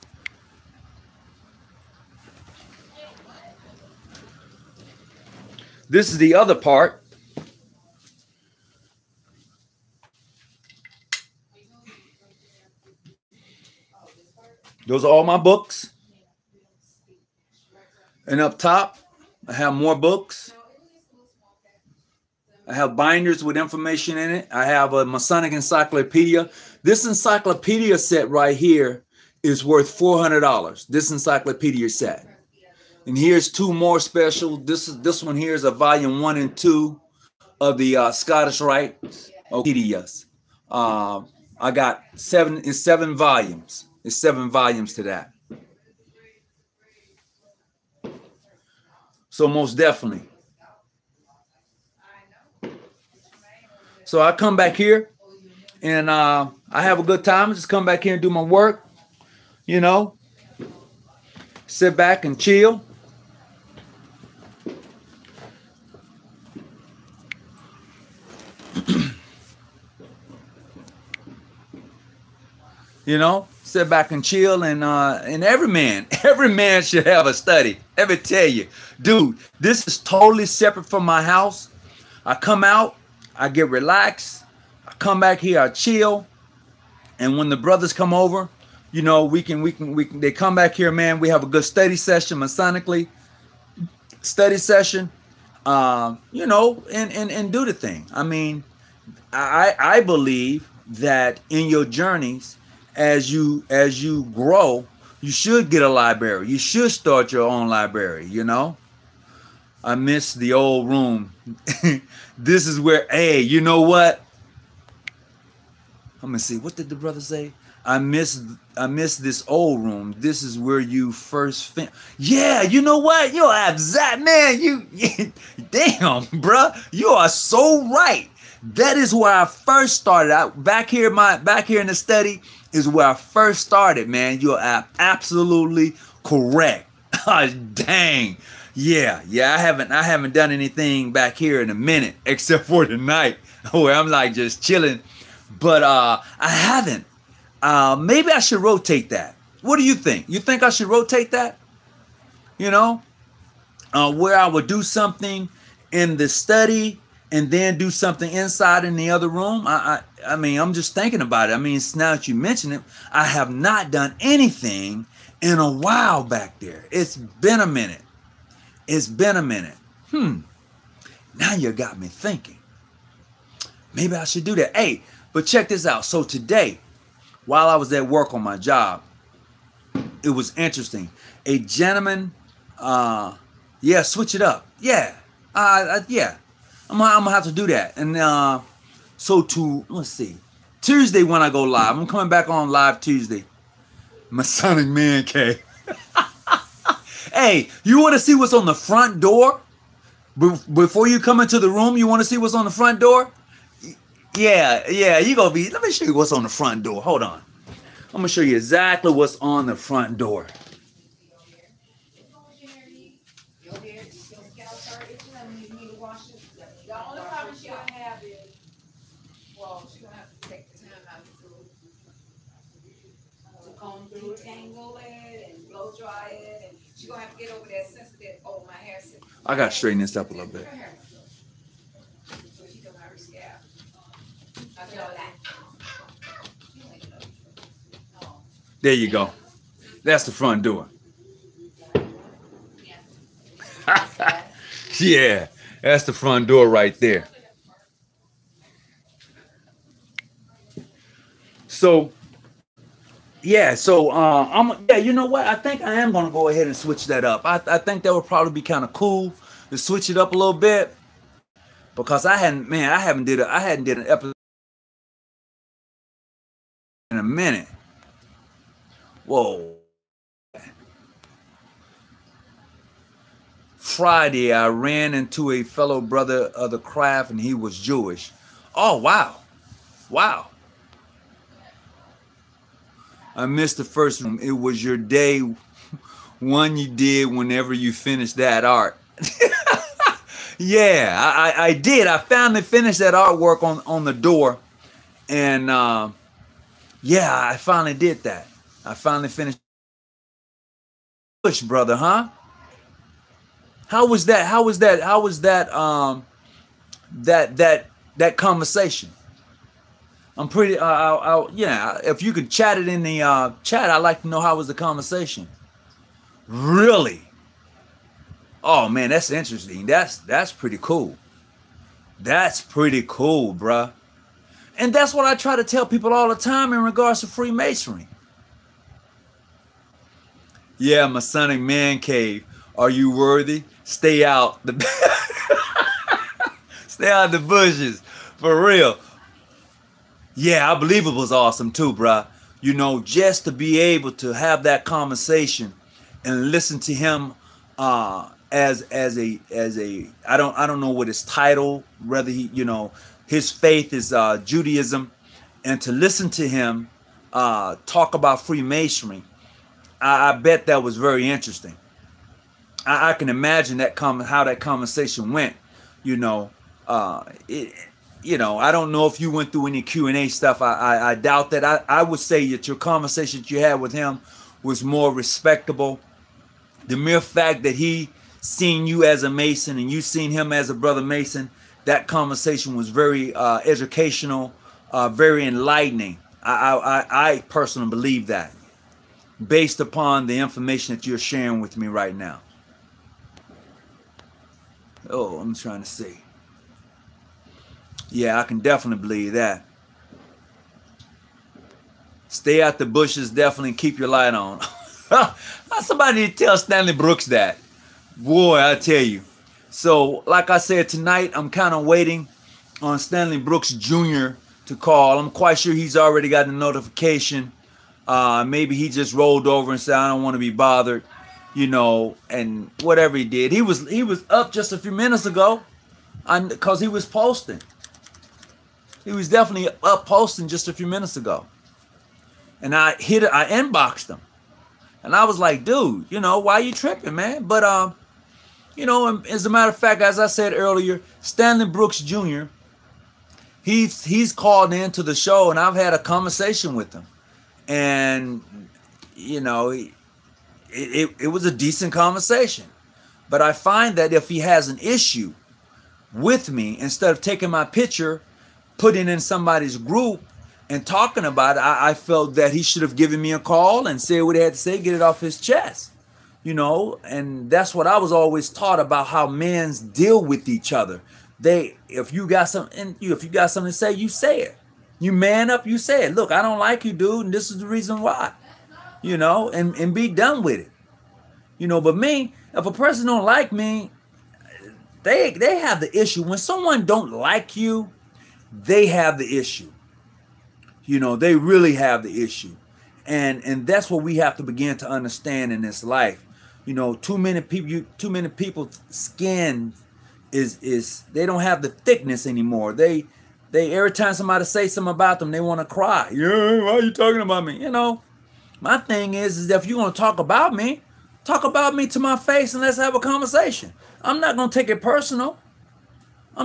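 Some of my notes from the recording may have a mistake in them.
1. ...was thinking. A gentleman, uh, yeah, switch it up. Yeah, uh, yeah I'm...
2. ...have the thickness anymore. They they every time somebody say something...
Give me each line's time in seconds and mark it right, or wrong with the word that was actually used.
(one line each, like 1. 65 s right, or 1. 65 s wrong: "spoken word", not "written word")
1. 180 s wrong: "interesting", not "thinking"
2. 501 s right.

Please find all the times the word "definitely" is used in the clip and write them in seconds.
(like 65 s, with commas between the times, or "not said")
49 s, 398 s, 403 s, 429 s.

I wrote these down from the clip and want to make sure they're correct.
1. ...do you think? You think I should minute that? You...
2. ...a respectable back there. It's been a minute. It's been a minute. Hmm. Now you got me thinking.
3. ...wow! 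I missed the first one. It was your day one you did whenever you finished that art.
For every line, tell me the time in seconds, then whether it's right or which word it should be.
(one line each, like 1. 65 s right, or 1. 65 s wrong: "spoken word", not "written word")
1. 149 s wrong: "rotate", not "minute"
2. 165 s wrong: "while", not "respectable"
3. 280 s right.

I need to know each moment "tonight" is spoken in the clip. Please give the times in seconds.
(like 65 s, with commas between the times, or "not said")
142 s, 410 s.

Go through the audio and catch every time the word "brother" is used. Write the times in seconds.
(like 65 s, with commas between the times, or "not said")
87 s, 116 s, 276 s, 301 s, 380 s.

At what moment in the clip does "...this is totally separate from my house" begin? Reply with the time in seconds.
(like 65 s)
79 s.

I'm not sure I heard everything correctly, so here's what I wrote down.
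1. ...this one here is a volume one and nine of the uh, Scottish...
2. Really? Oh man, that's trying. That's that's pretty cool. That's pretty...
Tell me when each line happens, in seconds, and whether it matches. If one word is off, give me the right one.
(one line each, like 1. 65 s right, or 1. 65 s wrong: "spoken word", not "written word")
1. 35 s wrong: "two", not "nine"
2. 316 s wrong: "interesting", not "trying".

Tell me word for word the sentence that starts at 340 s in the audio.
Yeah, I believe it was awesome too, bruh.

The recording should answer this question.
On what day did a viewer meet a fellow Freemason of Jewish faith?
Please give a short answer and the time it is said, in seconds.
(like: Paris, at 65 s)
Friday, at 273 s.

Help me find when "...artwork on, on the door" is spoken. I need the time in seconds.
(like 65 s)
293 s.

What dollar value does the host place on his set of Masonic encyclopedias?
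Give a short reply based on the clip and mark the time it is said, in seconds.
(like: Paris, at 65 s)
$400, at 29 s.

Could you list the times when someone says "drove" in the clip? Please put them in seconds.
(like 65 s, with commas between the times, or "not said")
not said.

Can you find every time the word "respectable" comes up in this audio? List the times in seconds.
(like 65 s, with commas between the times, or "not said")
375 s.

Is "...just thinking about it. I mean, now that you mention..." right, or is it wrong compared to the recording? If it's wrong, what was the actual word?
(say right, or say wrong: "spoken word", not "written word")
right.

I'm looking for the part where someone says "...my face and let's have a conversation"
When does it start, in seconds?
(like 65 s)
511 s.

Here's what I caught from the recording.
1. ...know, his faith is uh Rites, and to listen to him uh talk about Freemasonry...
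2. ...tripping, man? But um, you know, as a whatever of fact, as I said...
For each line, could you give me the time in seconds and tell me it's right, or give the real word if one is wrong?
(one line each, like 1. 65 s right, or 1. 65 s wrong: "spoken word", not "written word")
1. 352 s wrong: "Judaism", not "Rites"
2. 436 s wrong: "matter", not "whatever".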